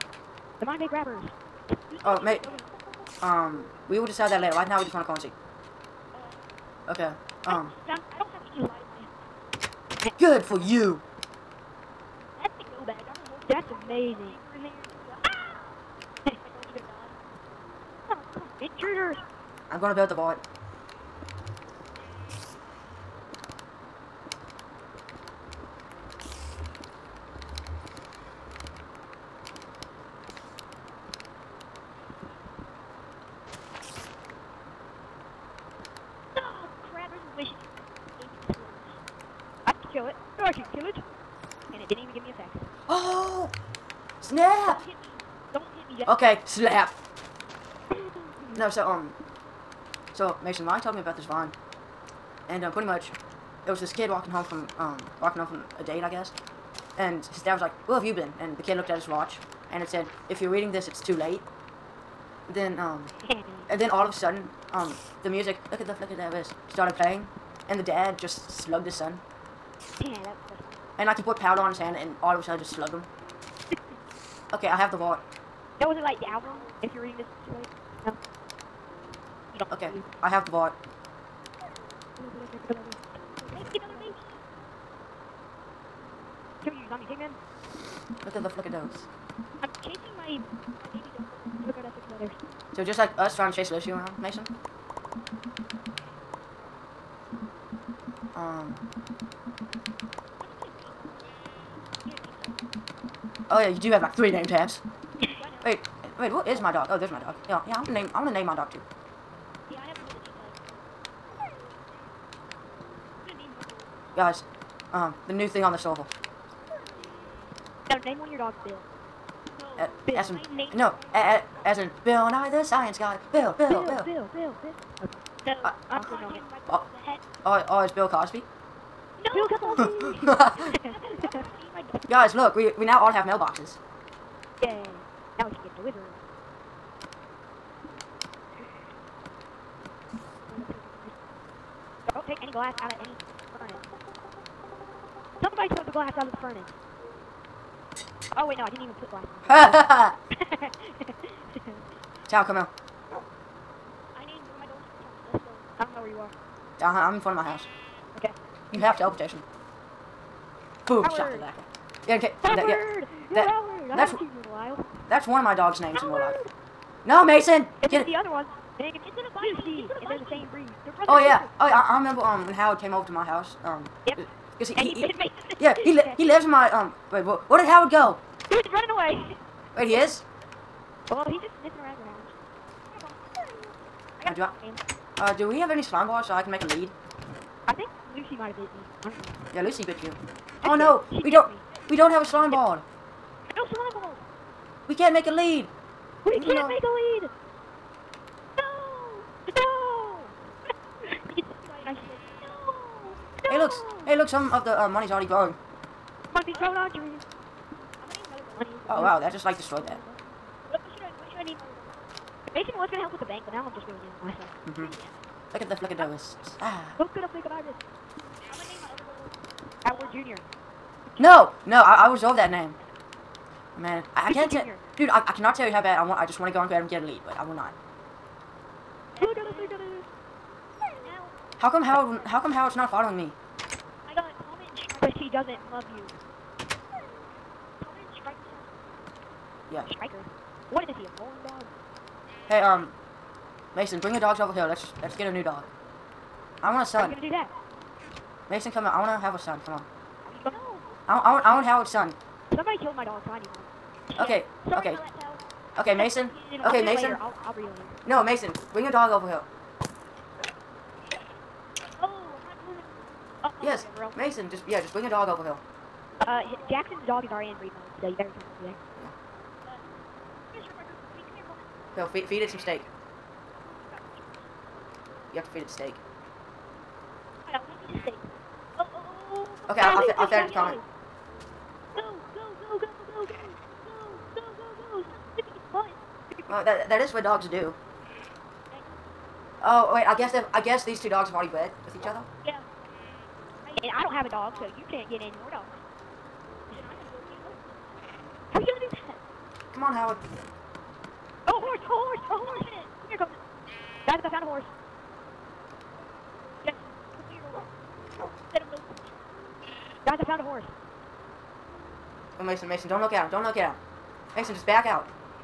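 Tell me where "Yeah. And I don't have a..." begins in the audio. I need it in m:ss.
4:52.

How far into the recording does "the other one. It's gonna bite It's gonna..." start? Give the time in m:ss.
2:48.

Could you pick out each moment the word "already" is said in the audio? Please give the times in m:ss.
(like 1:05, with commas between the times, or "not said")
3:25, 4:27, 4:51.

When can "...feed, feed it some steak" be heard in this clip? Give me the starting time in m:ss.
4:32.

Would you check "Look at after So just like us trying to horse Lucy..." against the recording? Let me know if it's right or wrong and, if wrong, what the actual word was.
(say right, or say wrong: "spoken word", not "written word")
wrong: "chase", not "horse".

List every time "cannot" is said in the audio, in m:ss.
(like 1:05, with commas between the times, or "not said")
3:45.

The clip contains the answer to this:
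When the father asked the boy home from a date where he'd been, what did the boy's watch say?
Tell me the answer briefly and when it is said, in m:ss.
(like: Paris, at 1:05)
If you're reading this, it's too late, at 1:00.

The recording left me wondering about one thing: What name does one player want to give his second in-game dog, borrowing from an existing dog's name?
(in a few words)
Howard Jr.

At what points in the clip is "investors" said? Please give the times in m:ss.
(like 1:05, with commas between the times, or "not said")
not said.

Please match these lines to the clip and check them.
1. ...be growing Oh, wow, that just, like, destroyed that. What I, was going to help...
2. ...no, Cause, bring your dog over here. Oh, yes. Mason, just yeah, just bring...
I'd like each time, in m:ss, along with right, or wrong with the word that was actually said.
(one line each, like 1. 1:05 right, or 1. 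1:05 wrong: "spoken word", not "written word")
1. 3:26 right
2. 4:18 wrong: "Mason", not "Cause".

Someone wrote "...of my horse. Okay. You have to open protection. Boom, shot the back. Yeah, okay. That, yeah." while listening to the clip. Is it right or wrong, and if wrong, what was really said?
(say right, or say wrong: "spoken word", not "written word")
wrong: "house", not "horse".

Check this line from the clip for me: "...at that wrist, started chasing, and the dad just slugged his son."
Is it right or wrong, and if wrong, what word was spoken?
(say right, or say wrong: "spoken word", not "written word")
wrong: "playing", not "chasing".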